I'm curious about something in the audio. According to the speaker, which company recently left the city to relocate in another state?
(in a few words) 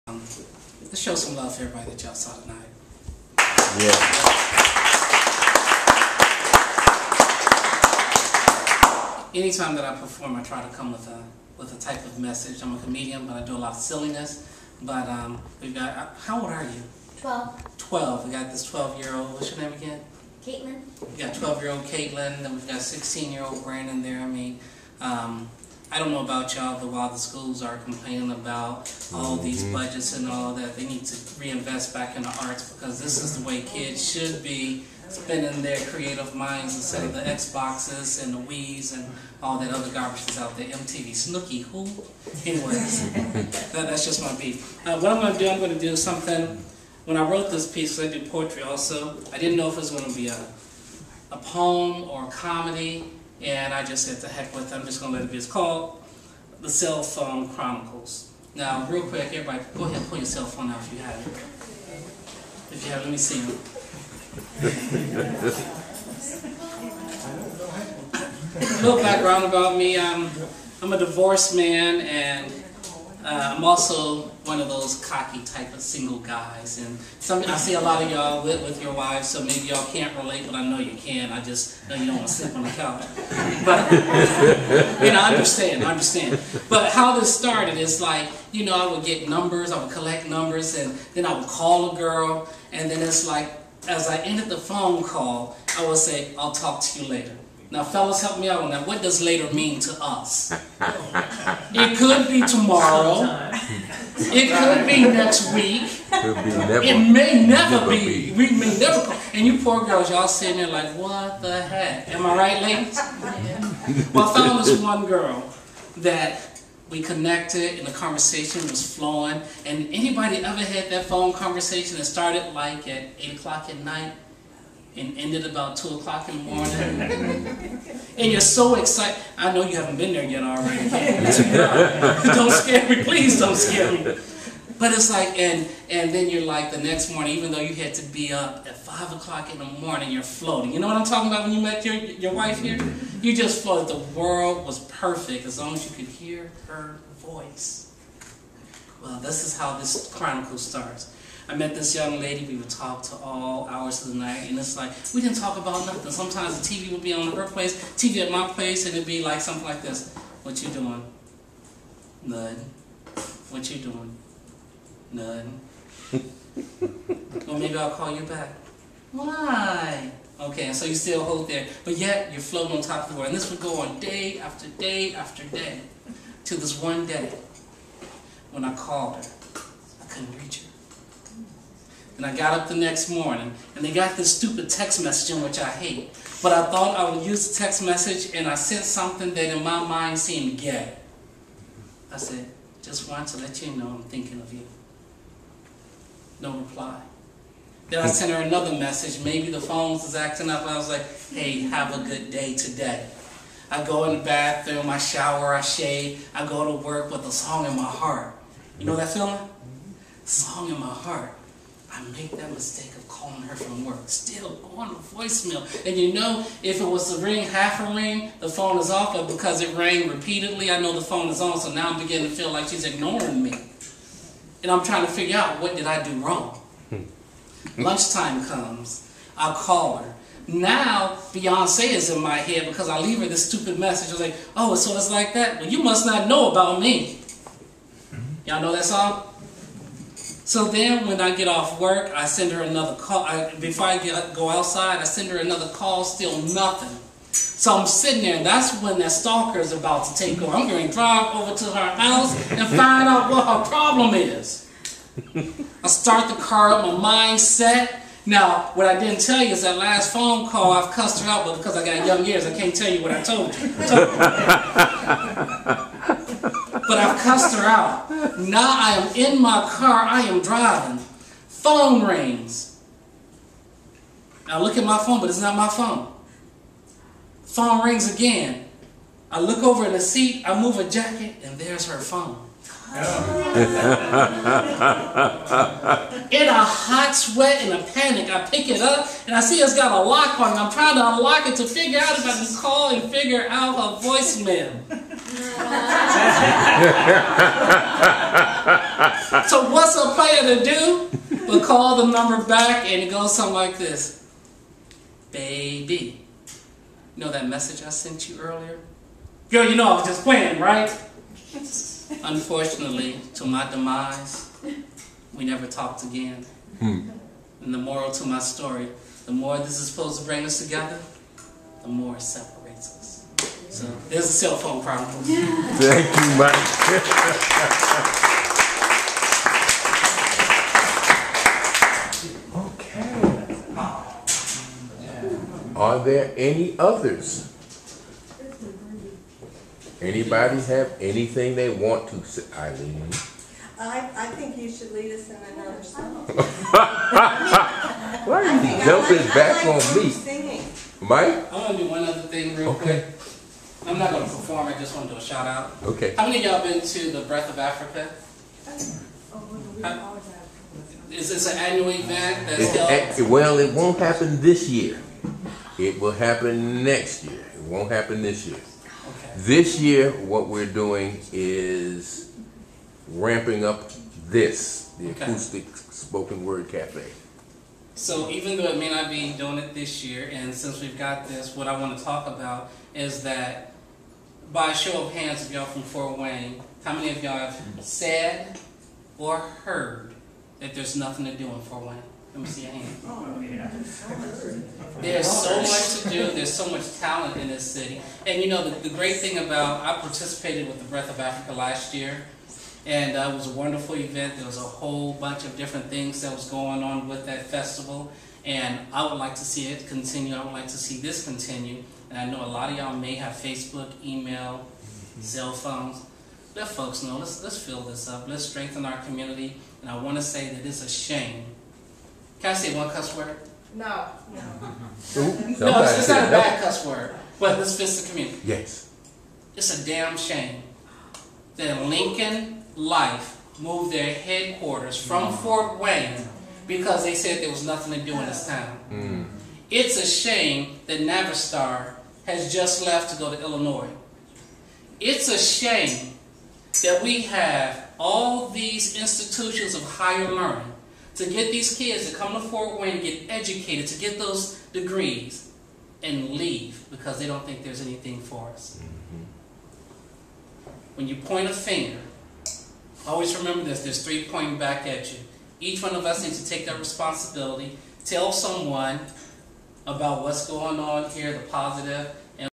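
Navistar.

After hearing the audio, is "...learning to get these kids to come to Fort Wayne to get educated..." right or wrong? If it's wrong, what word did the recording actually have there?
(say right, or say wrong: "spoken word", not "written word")
right.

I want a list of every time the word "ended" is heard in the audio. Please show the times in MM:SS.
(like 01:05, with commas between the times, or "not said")
01:34, 02:05.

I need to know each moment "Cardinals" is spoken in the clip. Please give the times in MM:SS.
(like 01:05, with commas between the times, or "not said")
not said.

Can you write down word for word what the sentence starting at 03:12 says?
I said, just want to let you know I'm thinking of you.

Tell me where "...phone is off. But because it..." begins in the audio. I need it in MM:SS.
03:38.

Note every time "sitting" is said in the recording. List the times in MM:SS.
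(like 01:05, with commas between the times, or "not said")
01:50, 04:07.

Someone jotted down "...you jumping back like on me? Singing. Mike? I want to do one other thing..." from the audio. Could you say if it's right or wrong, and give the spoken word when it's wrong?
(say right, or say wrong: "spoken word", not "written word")
right.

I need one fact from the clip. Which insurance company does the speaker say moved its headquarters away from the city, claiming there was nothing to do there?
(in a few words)
Lincoln Life.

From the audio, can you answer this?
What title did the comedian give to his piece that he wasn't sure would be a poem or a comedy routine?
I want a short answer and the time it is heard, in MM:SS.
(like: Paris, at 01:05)
The Cell Phone Chronicles, at 00:56.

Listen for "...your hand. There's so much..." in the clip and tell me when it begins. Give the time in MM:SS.
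06:32.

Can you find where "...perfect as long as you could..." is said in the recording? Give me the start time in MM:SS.
02:24.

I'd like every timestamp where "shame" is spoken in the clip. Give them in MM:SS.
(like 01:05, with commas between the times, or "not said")
07:00, 07:10, 07:20, 07:25.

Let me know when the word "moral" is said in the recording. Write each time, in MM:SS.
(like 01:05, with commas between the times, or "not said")
05:17.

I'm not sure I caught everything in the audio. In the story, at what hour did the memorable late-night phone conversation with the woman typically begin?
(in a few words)
8 o'clock.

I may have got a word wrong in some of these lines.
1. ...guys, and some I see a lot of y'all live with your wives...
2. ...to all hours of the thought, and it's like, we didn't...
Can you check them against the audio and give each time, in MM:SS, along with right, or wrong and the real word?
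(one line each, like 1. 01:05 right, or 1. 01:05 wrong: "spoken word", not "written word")
1. 01:16 right
2. 02:33 wrong: "night", not "thought".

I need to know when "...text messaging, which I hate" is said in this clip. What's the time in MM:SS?
03:04.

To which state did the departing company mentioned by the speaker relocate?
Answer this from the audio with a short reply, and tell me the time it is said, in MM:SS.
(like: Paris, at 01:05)
Illinois, at 07:23.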